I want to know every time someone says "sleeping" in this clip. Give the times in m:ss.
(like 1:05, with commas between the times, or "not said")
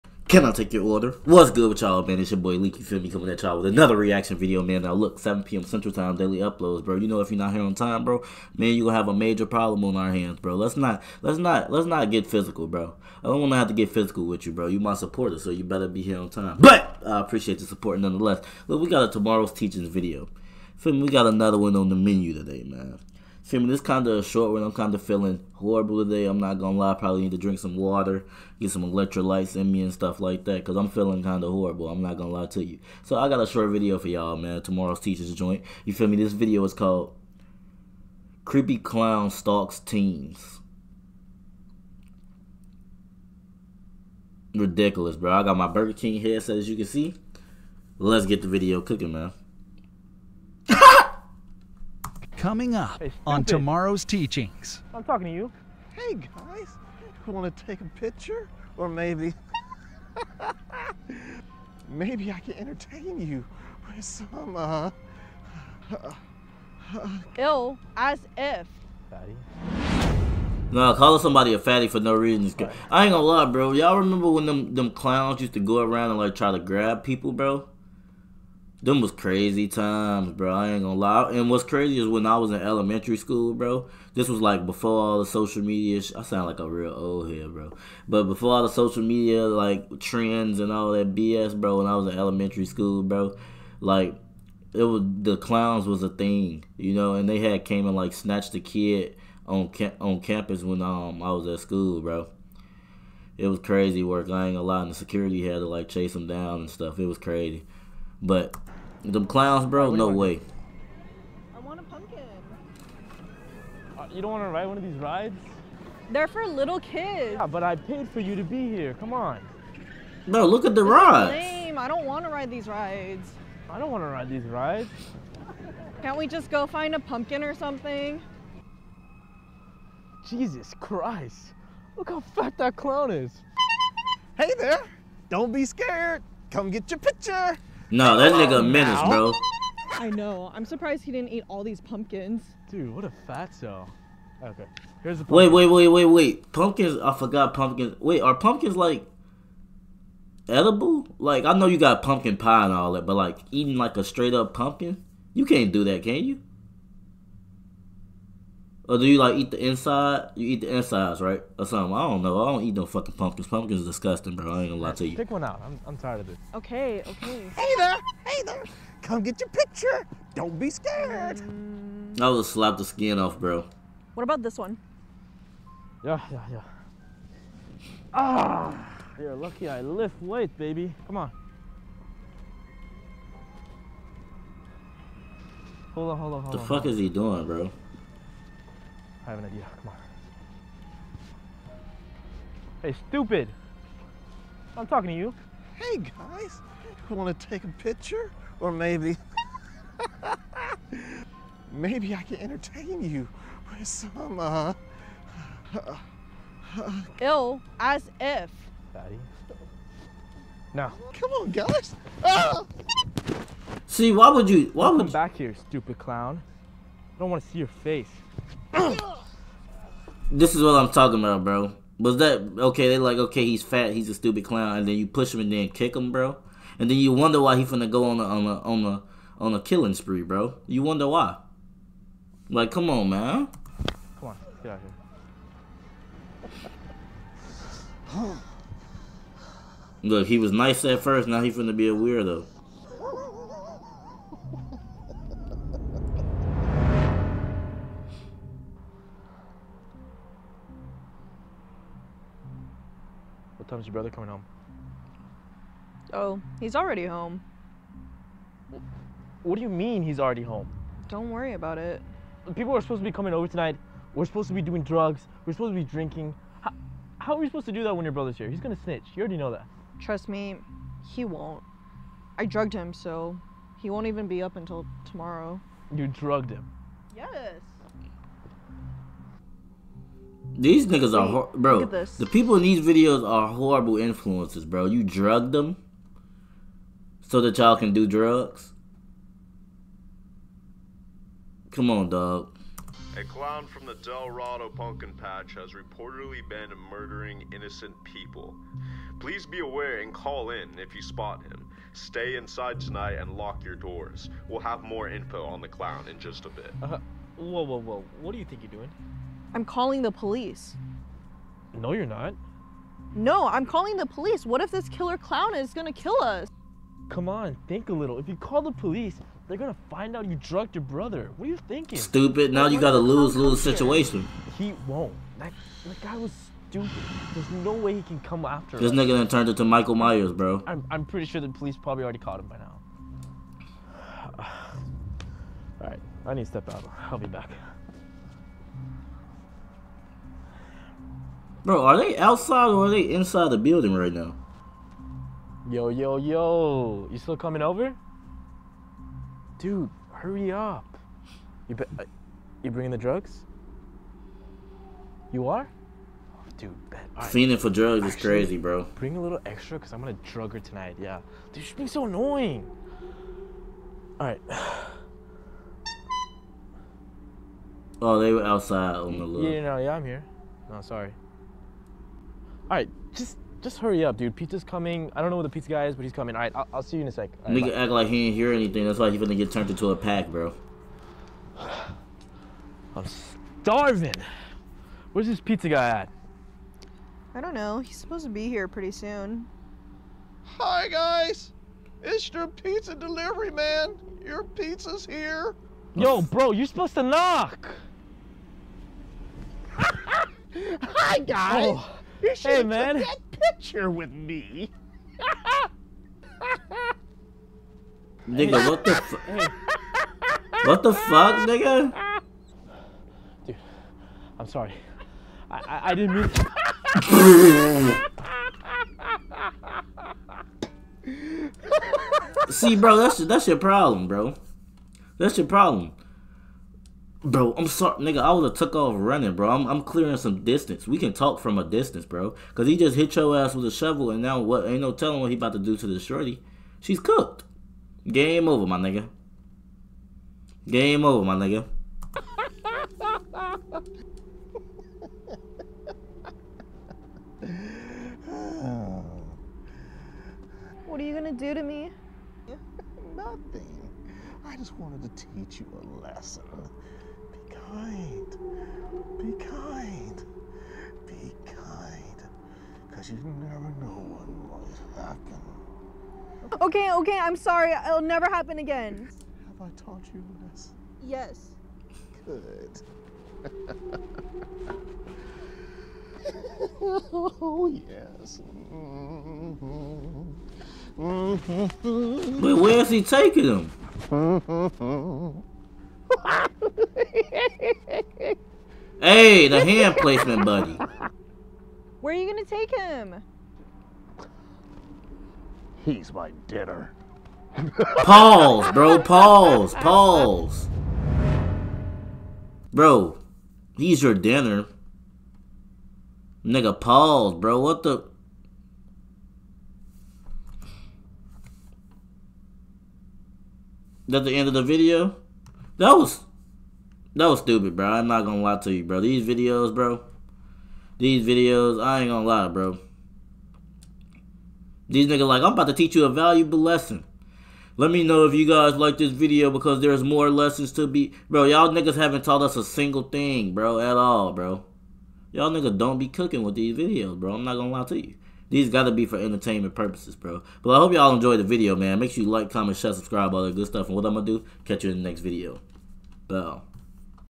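not said.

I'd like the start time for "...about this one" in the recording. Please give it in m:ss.
2:54.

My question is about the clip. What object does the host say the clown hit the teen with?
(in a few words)
shovel.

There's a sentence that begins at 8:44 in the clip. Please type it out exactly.
These niggas like, I'm about to teach you a valuable lesson.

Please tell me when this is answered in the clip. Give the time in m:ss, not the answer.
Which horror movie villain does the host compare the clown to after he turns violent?
5:29.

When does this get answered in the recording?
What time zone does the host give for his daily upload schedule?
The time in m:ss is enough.
0:05.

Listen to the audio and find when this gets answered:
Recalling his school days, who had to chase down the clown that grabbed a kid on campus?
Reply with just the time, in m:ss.
1:44.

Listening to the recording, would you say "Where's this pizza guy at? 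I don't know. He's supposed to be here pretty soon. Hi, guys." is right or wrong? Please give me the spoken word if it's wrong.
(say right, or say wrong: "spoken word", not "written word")
right.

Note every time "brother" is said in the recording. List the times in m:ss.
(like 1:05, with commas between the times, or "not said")
4:13, 4:28, 5:20.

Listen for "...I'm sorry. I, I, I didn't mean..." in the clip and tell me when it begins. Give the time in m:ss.
6:54.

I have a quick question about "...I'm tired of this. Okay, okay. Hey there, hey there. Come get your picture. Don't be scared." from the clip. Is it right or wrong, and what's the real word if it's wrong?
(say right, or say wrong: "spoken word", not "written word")
right.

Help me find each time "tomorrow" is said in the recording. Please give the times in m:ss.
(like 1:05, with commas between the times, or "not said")
0:19, 0:34, 0:53, 4:35.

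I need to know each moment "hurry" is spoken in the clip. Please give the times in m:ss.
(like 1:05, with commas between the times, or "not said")
5:50, 6:13.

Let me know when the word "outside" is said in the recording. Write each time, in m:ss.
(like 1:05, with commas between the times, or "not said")
5:42, 6:08.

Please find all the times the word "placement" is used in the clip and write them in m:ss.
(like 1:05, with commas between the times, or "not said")
8:09.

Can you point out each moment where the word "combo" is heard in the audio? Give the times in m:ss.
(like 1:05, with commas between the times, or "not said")
not said.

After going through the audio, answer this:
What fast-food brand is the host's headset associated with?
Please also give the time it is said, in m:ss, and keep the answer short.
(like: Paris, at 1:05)
Burger King, at 0:45.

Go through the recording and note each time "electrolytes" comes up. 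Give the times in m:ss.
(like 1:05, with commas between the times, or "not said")
0:28.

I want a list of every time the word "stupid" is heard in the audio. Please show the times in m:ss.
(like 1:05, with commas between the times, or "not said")
3:13, 3:35, 3:44, 5:21, 5:26, 8:37.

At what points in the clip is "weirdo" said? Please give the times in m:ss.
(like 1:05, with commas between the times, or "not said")
4:01.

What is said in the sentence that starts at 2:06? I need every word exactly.
Can't we just go find a pumpkin or something?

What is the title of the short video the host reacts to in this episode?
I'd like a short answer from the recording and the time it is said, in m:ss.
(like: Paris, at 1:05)
Creepy Clown Stalks Teens, at 0:38.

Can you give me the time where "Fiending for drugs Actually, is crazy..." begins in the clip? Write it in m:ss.
5:57.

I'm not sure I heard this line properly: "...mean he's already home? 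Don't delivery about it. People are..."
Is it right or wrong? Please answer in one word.
wrong.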